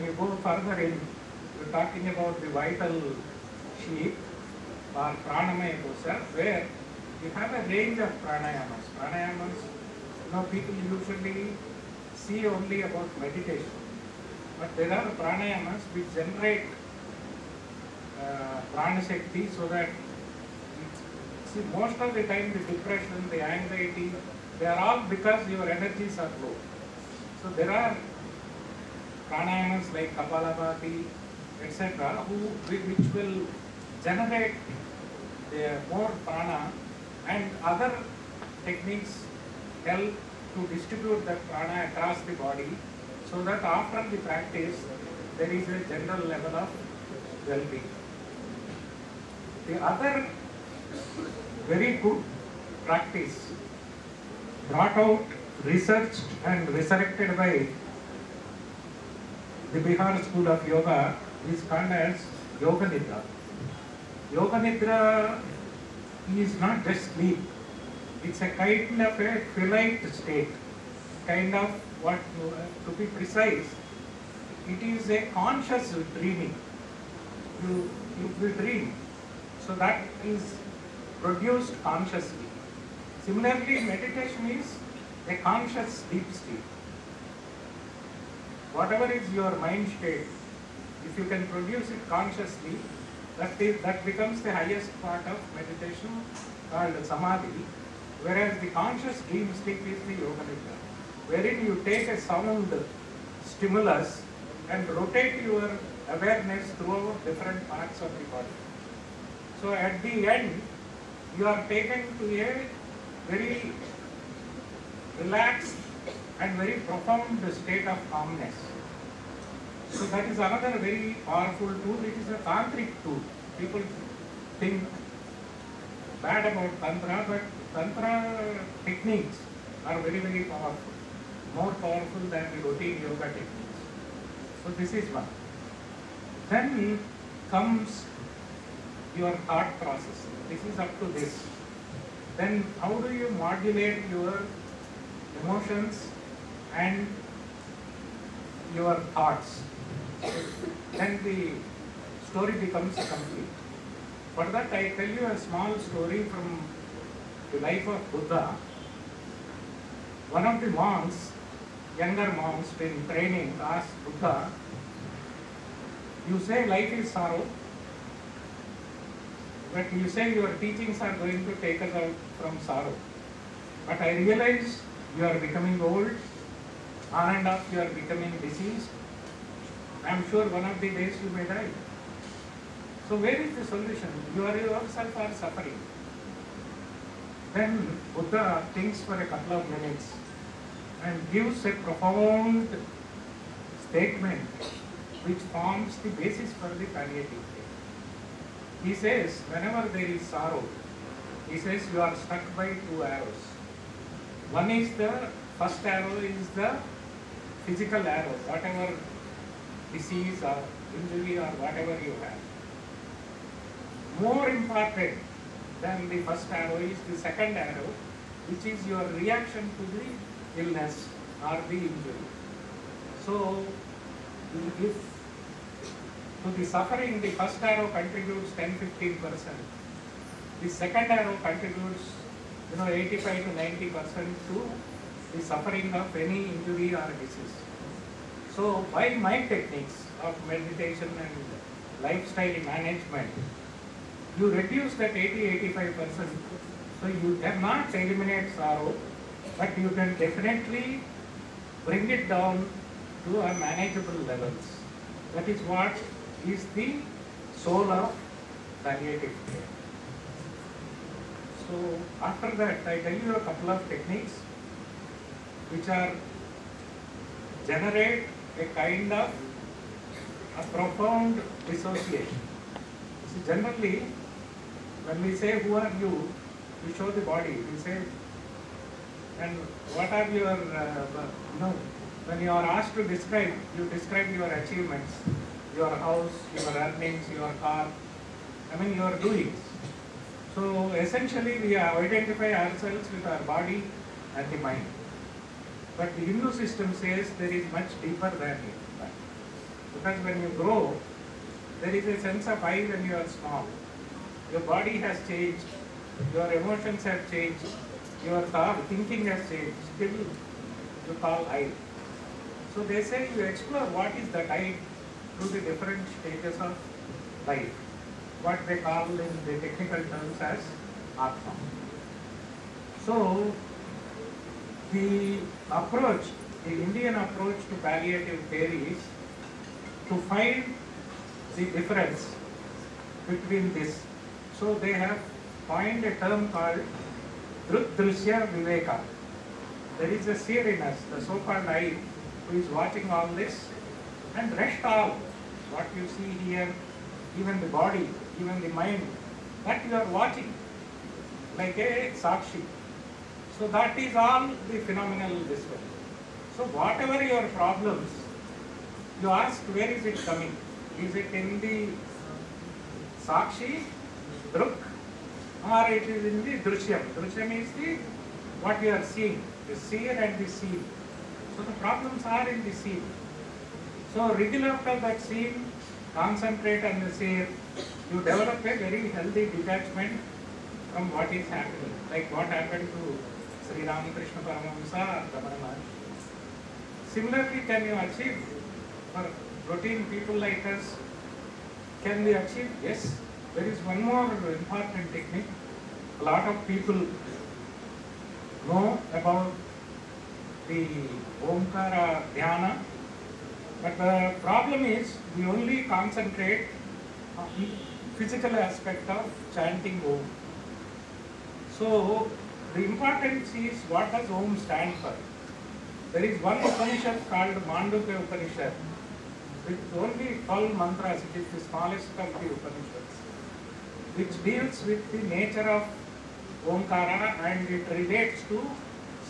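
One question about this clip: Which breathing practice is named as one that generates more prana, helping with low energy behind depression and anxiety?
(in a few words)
Kapalabhati.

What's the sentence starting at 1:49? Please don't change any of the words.
So at the end, you are taken to a very relaxed and very profound state of calmness.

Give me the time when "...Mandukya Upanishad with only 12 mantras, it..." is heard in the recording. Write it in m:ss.
6:57.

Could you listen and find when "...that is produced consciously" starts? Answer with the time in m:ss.
1:19.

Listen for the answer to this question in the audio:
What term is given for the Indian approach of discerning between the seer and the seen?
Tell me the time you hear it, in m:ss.
5:37.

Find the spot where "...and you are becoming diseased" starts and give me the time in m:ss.
2:57.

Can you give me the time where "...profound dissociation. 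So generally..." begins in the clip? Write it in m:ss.
4:30.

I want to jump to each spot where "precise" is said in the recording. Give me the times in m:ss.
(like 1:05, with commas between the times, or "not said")
1:13.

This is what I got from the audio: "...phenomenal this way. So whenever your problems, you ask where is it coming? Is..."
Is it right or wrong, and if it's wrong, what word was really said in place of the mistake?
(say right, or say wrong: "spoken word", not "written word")
wrong: "whatever", not "whenever".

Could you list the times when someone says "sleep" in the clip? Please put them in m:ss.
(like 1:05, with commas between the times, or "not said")
1:07, 1:26.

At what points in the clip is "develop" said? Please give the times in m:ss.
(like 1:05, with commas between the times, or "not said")
6:18.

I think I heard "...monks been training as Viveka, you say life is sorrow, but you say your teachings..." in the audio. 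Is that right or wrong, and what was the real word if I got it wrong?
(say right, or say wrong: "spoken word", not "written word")
wrong: "Buddha", not "Viveka".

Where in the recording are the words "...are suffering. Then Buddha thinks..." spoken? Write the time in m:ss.
3:05.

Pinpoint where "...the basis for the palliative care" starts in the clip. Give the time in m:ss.
3:15.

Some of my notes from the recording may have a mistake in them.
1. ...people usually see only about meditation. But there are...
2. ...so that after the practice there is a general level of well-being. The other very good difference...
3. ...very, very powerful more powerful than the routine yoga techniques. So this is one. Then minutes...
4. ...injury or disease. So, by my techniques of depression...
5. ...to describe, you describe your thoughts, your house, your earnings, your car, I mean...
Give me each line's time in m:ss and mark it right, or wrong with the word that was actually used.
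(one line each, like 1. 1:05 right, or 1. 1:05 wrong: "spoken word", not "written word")
1. 0:10 right
2. 0:43 wrong: "practice", not "difference"
3. 2:09 wrong: "comes", not "minutes"
4. 3:56 wrong: "meditation", not "depression"
5. 4:42 wrong: "achievements", not "thoughts".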